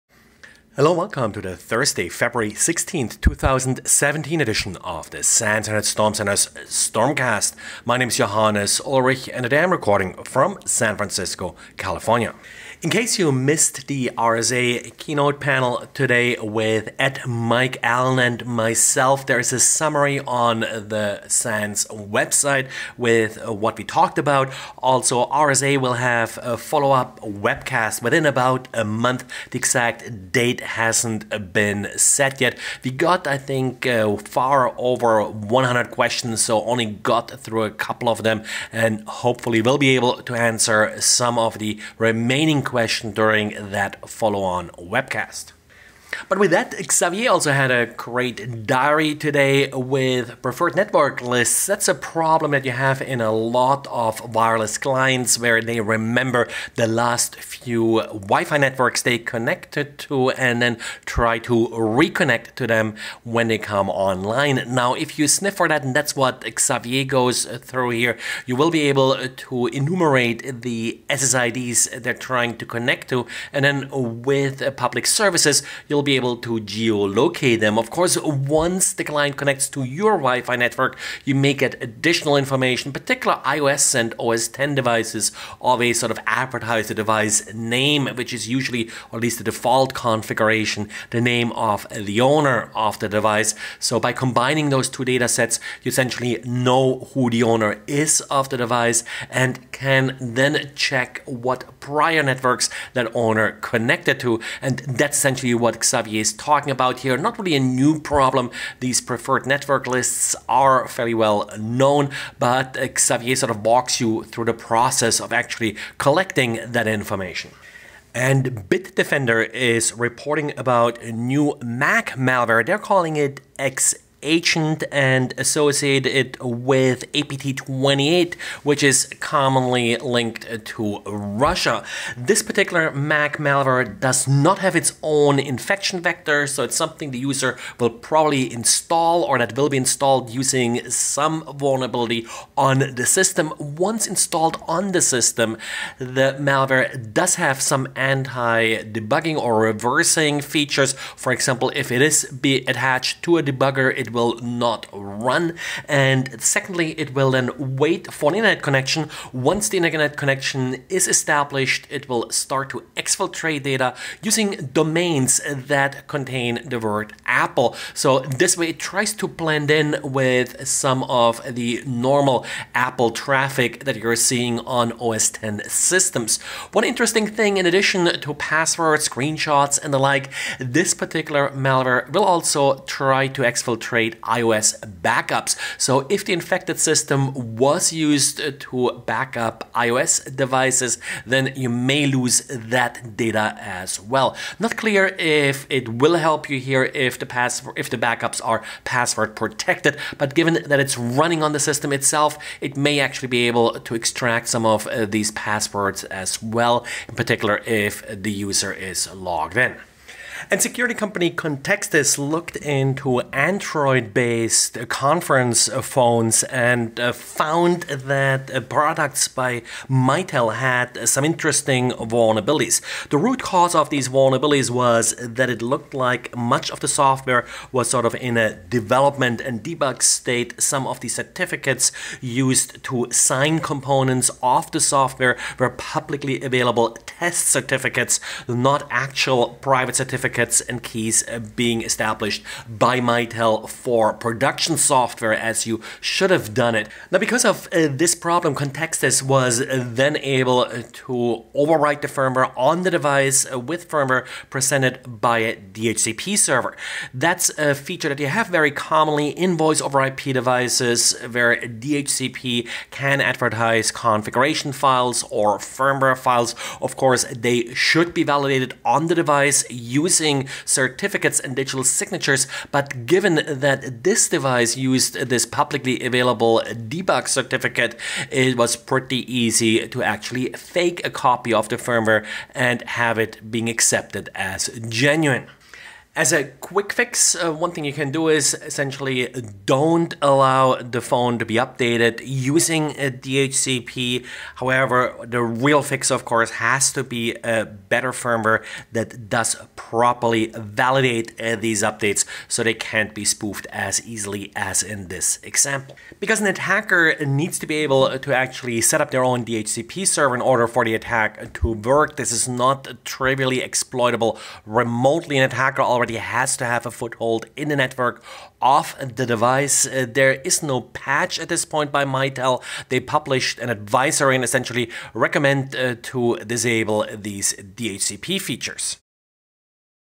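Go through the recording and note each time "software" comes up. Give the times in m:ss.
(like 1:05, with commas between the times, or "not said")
3:46, 3:54, 4:04.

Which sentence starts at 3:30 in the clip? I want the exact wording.
And security company Contextis looked into Android based conference phones and uh, found that uh, products by Mitel had some interesting vulnerabilities.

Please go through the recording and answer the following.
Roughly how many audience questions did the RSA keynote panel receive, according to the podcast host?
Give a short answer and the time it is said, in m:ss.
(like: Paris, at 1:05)
over 100, at 0:34.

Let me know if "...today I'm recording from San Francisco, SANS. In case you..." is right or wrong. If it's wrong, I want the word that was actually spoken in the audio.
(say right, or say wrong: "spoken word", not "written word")
wrong: "California", not "SANS".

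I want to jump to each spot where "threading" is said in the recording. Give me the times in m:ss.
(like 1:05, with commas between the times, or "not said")
not said.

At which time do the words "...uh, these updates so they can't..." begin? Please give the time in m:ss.
5:01.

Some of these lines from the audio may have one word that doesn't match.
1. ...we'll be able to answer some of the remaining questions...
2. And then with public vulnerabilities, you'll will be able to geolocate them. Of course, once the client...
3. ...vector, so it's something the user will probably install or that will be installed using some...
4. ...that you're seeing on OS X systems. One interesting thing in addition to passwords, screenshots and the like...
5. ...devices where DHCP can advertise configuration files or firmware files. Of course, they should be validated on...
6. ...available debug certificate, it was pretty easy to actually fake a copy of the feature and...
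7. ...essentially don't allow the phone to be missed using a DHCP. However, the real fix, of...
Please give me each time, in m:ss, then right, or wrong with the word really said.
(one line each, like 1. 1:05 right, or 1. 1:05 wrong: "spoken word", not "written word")
1. 0:39 right
2. 1:13 wrong: "services", not "vulnerabilities"
3. 2:16 right
4. 2:53 right
5. 4:20 right
6. 4:36 wrong: "firmware", not "feature"
7. 4:48 wrong: "updated", not "missed".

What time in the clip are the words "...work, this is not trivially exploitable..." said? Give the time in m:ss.
5:11.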